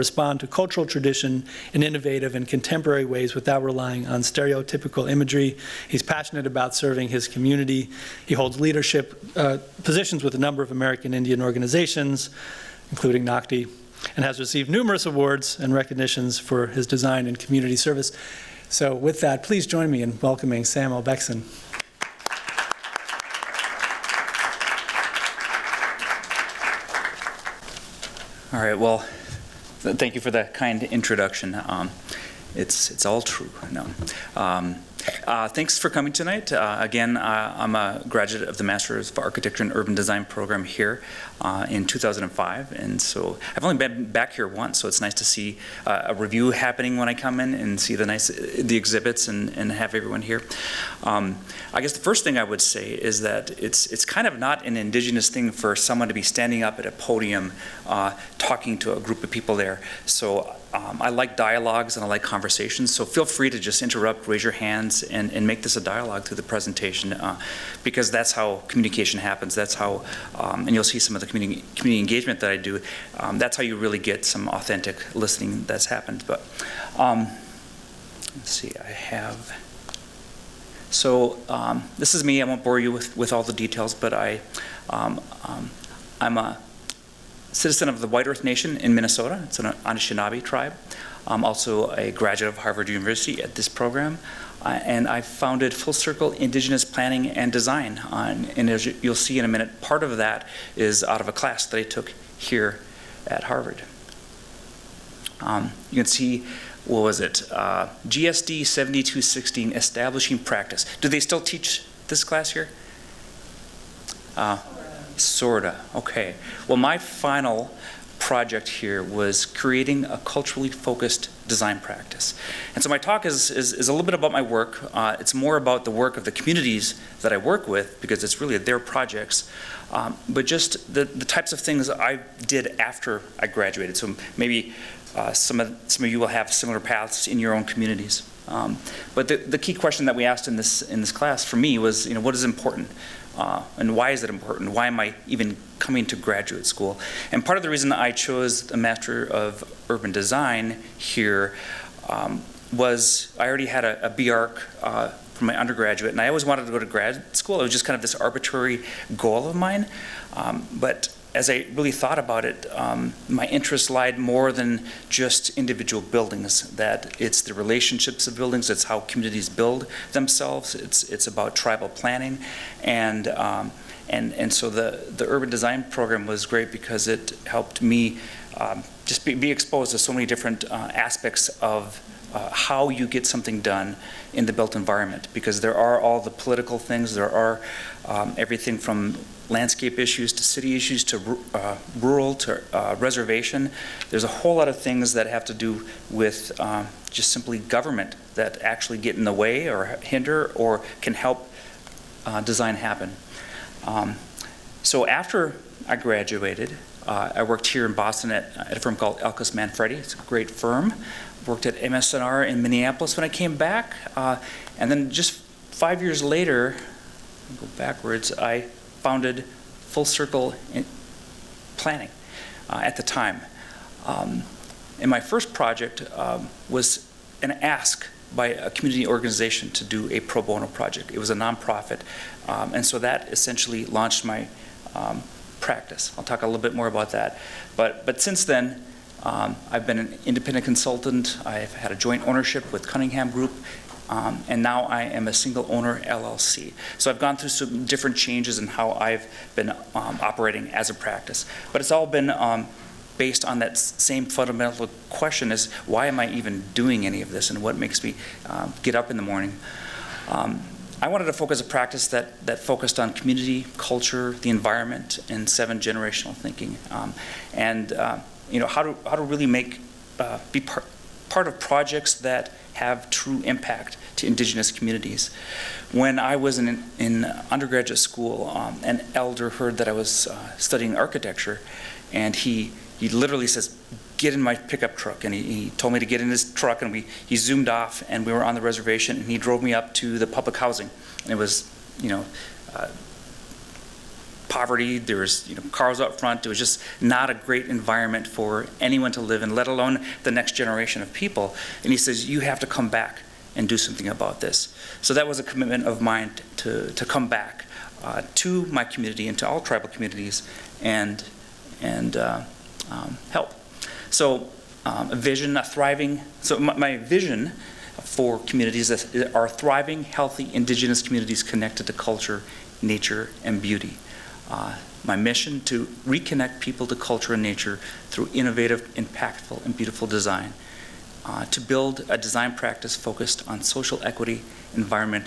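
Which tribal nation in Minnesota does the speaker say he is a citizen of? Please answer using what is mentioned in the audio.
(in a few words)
White Earth Nation.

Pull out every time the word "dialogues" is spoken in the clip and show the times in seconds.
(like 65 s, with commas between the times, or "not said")
61 s, 65 s.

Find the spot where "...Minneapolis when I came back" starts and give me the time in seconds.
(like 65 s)
212 s.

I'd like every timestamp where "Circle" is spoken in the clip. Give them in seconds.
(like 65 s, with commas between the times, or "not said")
95 s, 220 s.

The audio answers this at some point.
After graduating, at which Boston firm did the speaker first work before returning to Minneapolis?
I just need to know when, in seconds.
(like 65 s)
209 s.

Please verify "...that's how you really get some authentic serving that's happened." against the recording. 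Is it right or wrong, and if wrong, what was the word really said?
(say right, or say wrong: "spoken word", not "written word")
wrong: "listening", not "serving".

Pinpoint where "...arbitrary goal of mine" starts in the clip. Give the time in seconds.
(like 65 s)
158 s.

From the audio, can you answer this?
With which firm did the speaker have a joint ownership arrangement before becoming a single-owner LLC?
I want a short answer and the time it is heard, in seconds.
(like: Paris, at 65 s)
Cunningham Group, at 242 s.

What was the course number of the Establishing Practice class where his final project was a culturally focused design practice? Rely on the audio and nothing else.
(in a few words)
GSD 7216.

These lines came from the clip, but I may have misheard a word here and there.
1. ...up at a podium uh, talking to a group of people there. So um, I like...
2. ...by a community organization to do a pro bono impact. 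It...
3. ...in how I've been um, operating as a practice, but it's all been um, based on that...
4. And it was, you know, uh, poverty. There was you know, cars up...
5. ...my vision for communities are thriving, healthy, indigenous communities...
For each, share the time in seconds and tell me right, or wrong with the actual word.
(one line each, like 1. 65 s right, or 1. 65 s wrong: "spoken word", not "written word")
1. 56 s right
2. 228 s wrong: "project", not "impact"
3. 248 s right
4. 291 s right
5. 316 s right.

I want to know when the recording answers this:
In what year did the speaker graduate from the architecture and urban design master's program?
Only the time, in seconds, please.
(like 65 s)
41 s.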